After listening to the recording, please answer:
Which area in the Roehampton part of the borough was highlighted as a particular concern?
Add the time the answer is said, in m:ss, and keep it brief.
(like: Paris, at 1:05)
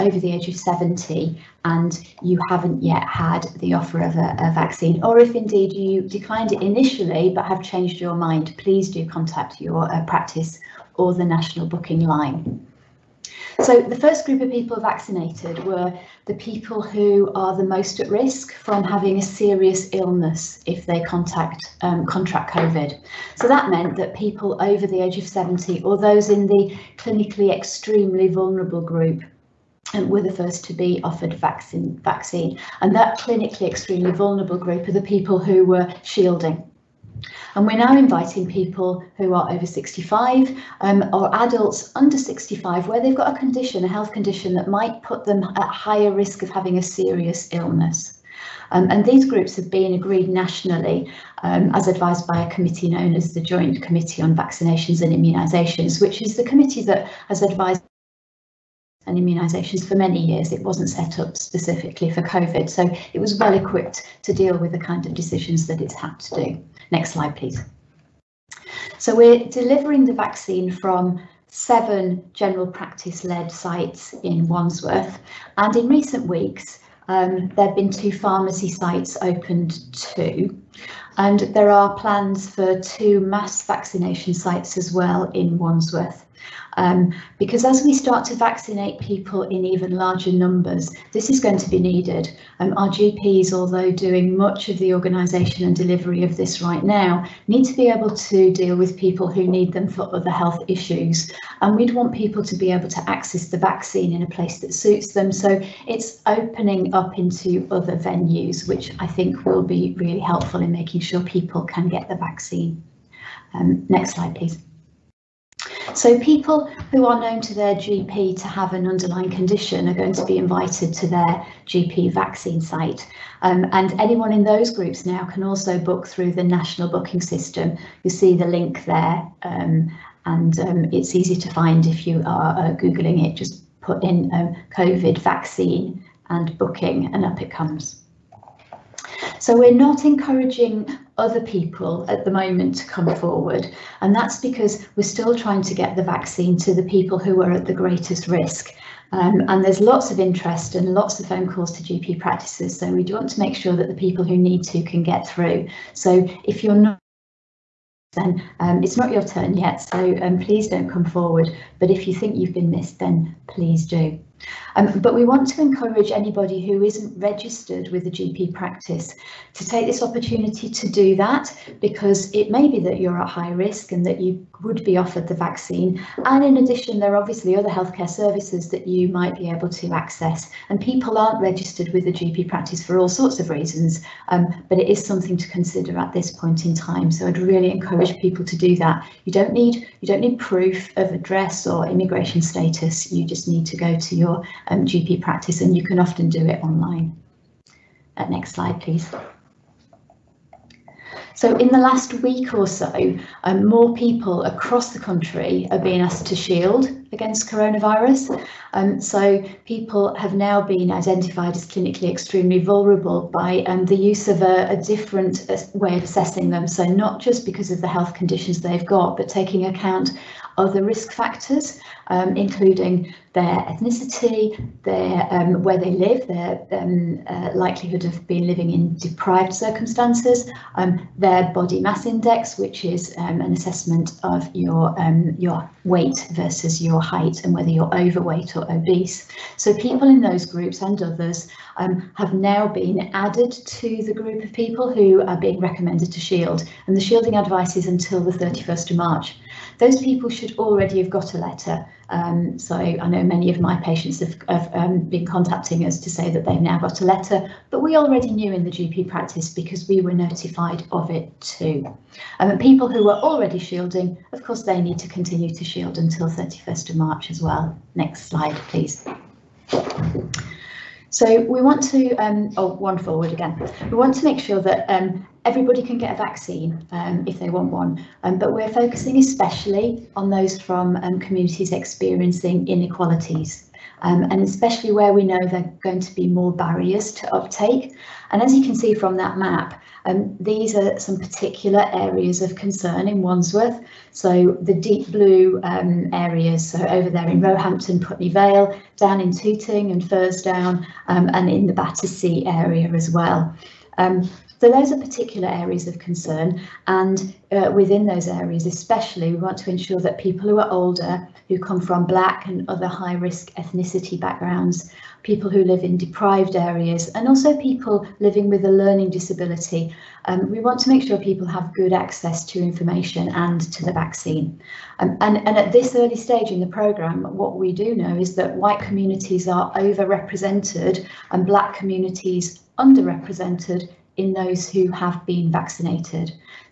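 Putney Vale, at 4:57.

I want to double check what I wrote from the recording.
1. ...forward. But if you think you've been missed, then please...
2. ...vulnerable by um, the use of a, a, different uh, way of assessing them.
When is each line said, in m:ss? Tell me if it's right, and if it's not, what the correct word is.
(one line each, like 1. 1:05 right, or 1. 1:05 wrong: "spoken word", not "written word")
1. 2:41 right
2. 3:32 right.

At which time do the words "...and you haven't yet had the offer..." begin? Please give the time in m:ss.
0:01.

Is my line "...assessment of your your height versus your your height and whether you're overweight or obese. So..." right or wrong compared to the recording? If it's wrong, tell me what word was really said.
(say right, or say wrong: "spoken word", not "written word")
wrong: "weight", not "height".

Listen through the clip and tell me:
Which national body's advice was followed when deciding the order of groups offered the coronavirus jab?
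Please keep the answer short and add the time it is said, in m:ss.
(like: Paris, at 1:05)
Joint Committee on Vaccinations and Immunisations, at 0:53.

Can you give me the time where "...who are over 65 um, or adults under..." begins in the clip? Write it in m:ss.
0:39.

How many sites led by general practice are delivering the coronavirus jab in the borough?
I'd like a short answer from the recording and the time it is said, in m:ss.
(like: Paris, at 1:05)
7, at 1:11.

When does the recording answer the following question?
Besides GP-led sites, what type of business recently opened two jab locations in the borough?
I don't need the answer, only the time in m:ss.
1:18.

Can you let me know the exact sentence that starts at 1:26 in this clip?
Um, because as we start to vaccinate people in even larger numbers, this is going to be needed.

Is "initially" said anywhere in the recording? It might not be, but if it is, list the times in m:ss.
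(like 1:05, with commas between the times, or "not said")
0:06.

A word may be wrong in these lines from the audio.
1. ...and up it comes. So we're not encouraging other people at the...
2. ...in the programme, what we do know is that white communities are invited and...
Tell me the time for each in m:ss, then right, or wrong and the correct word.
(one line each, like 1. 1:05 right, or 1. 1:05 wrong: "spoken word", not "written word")
1. 2:17 right
2. 5:26 wrong: "overrepresented", not "invited".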